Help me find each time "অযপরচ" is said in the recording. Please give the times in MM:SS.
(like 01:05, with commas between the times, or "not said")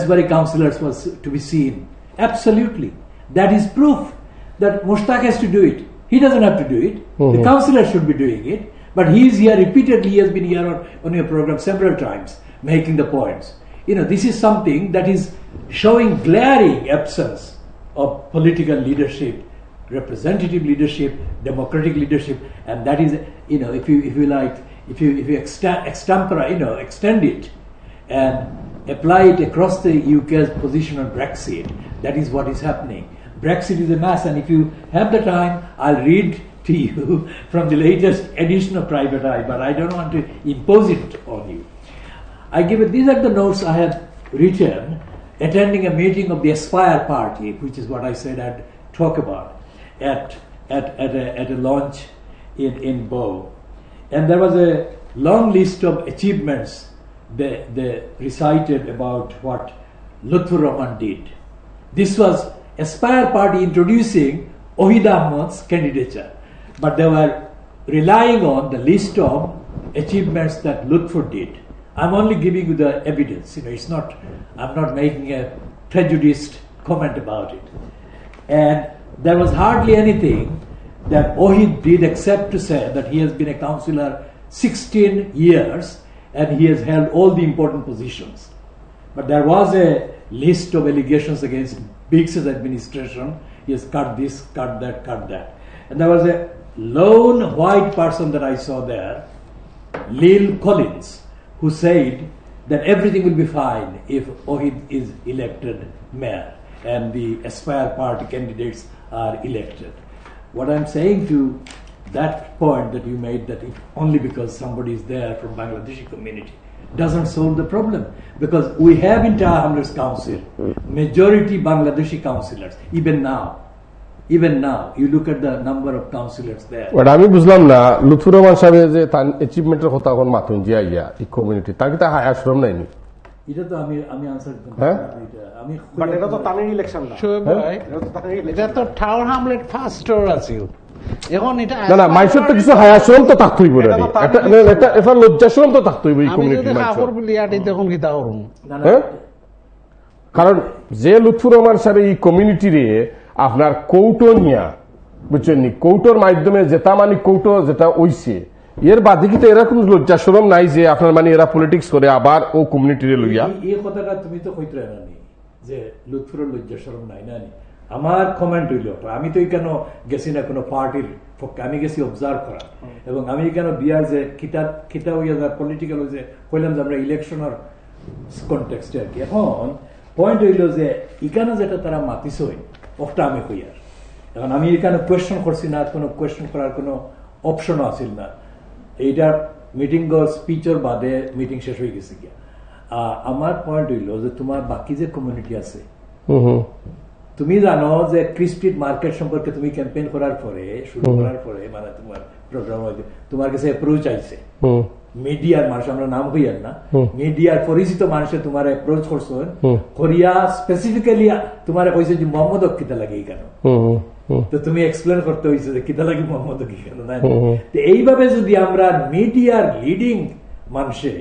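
03:23, 03:28.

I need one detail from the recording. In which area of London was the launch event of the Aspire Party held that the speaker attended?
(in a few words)
Bow.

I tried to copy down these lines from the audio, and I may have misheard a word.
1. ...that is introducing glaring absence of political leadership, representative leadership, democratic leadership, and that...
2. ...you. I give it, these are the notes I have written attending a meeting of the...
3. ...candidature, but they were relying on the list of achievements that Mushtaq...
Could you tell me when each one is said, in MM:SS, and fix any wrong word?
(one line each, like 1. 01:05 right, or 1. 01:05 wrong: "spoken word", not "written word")
1. 00:14 wrong: "showing", not "introducing"
2. 00:41 right
3. 01:05 wrong: "Lutfur", not "Mushtaq".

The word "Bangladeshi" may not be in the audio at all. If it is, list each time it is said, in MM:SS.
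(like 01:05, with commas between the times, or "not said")
01:55, 02:01.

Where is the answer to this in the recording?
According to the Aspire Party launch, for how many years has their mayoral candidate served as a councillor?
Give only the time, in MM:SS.
01:24.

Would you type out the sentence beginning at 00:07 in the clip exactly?
The counselor should be doing it.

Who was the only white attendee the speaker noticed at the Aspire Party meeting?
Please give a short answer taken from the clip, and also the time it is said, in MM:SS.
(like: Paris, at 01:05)
Lil Collins, at 01:40.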